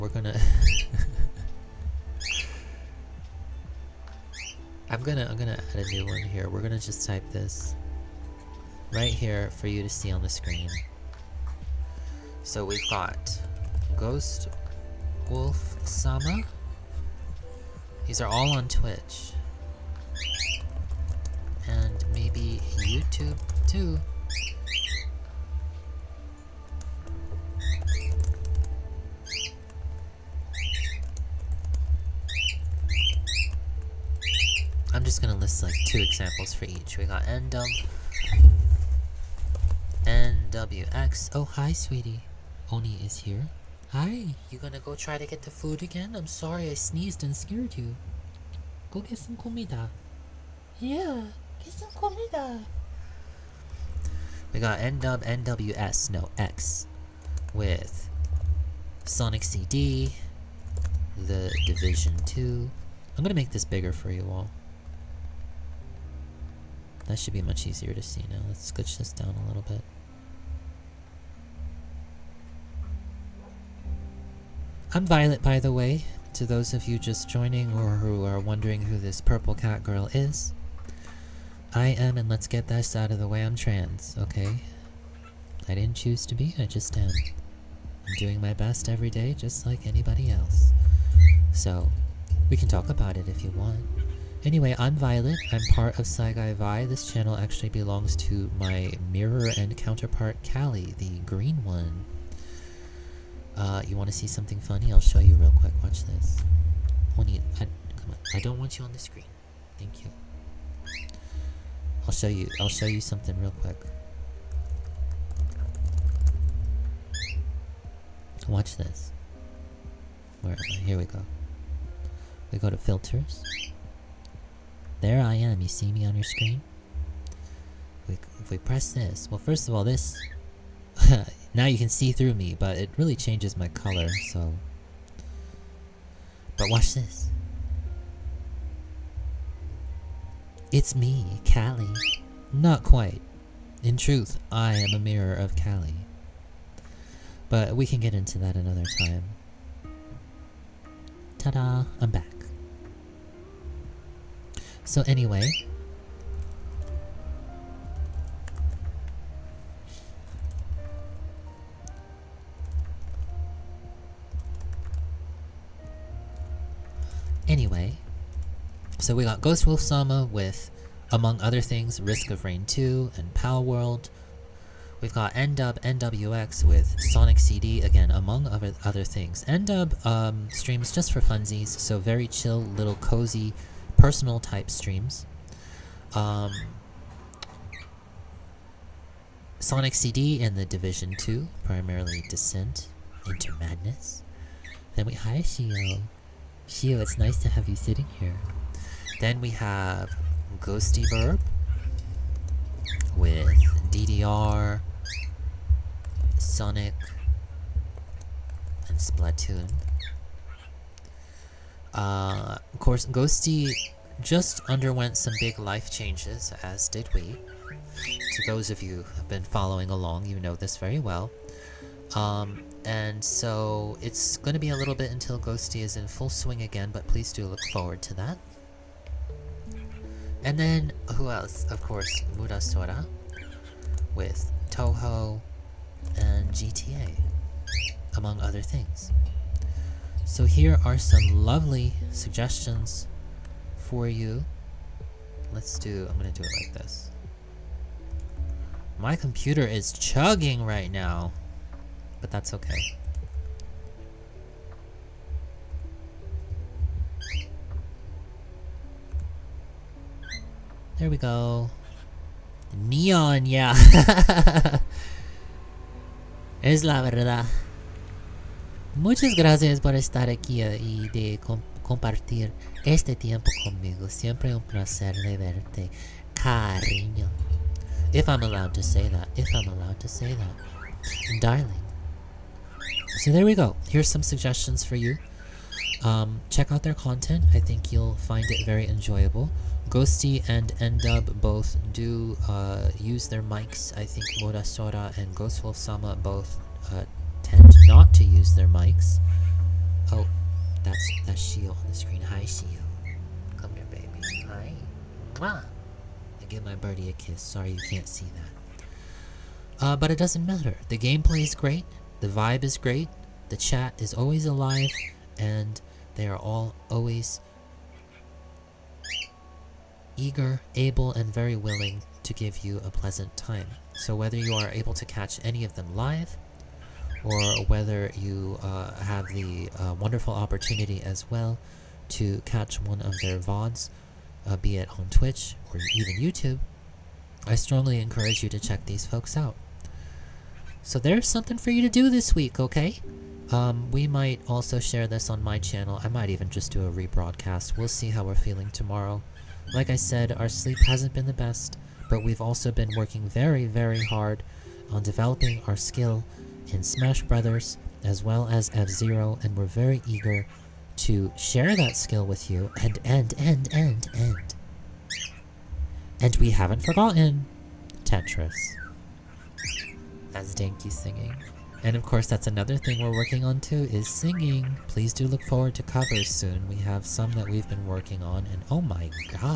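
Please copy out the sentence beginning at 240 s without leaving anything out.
So here are some lovely suggestions for you.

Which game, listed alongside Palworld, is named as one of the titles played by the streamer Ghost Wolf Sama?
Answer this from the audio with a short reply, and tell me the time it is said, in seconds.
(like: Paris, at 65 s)
Risk of Rain 2, at 172 s.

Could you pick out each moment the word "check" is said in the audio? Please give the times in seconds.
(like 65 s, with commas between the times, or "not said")
286 s, 338 s.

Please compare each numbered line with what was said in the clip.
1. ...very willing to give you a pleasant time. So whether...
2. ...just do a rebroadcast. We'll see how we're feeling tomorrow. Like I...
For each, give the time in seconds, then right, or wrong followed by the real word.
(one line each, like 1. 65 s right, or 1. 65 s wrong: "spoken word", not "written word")
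1. 321 s right
2. 346 s right.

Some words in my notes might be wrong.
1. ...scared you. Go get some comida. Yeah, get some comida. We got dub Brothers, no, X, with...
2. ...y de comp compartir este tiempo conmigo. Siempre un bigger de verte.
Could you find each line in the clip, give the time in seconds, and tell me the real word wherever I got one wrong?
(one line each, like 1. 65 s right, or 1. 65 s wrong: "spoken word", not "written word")
1. 47 s wrong: "NWS", not "Brothers"
2. 270 s wrong: "placer", not "bigger".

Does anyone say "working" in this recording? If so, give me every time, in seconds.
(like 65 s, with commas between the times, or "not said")
352 s, 373 s, 377 s.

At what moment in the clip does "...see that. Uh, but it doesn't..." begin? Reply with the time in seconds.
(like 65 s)
308 s.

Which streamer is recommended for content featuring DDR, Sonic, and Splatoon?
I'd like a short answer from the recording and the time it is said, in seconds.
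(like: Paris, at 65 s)
Ghostibirb, at 200 s.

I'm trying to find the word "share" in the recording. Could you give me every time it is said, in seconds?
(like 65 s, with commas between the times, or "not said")
344 s, 361 s.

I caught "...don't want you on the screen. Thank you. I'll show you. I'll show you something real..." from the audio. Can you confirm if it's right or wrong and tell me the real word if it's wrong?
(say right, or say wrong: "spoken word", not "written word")
right.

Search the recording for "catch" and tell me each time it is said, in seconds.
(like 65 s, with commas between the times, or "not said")
325 s, 332 s.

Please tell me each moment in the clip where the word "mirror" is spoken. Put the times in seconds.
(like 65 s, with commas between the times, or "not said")
99 s, 144 s.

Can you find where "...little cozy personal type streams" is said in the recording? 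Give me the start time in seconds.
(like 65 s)
182 s.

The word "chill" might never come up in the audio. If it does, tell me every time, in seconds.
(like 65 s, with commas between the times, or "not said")
182 s.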